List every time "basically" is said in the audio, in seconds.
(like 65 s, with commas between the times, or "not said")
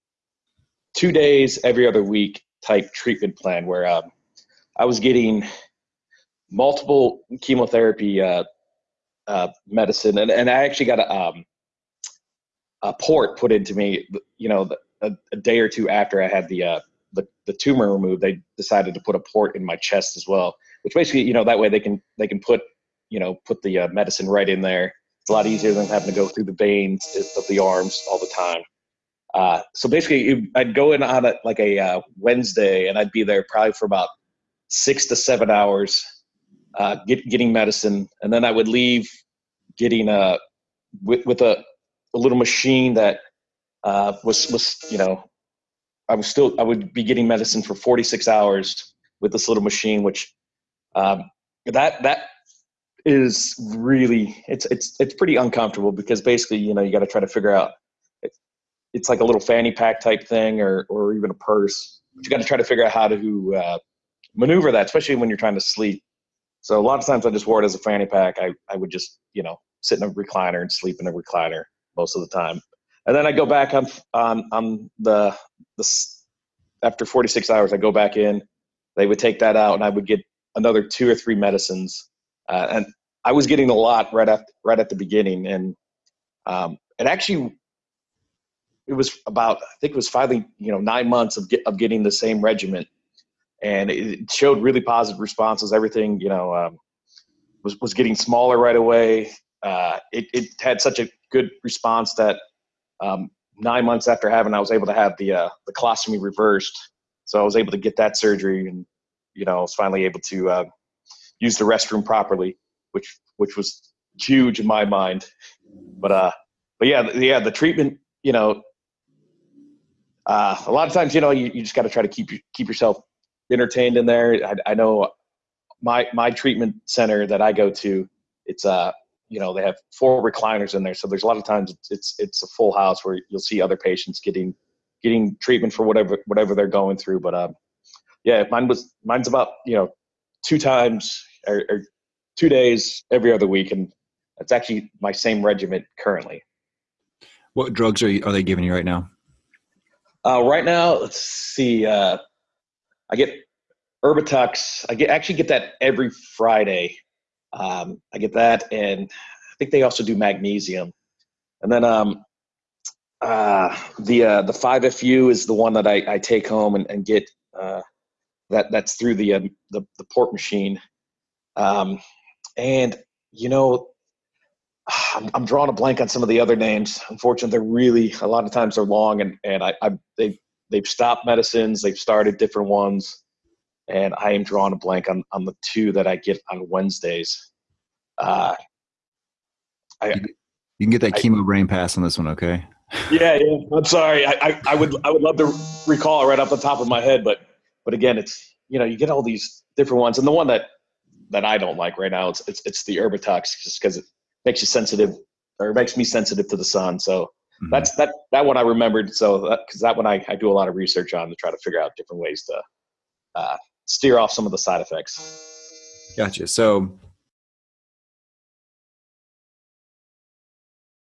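20 s, 29 s, 56 s.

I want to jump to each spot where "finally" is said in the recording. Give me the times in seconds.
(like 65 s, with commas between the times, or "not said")
90 s, 109 s.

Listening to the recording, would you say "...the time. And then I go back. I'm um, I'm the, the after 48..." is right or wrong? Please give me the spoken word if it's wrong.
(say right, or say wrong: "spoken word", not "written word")
wrong: "46", not "48".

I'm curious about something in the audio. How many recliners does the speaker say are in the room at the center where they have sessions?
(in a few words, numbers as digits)
4.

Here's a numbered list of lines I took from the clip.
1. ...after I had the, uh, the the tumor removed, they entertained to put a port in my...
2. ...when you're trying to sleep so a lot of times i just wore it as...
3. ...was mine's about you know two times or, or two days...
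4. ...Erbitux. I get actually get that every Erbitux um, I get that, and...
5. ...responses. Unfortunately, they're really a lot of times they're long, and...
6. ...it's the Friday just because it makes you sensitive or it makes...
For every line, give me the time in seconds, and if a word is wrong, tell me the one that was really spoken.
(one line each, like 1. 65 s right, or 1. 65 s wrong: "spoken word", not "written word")
1. 15 s wrong: "decided", not "entertained"
2. 65 s right
3. 138 s right
4. 154 s wrong: "Friday", not "Erbitux"
5. 176 s wrong: "names", not "responses"
6. 202 s wrong: "Erbitux", not "Friday".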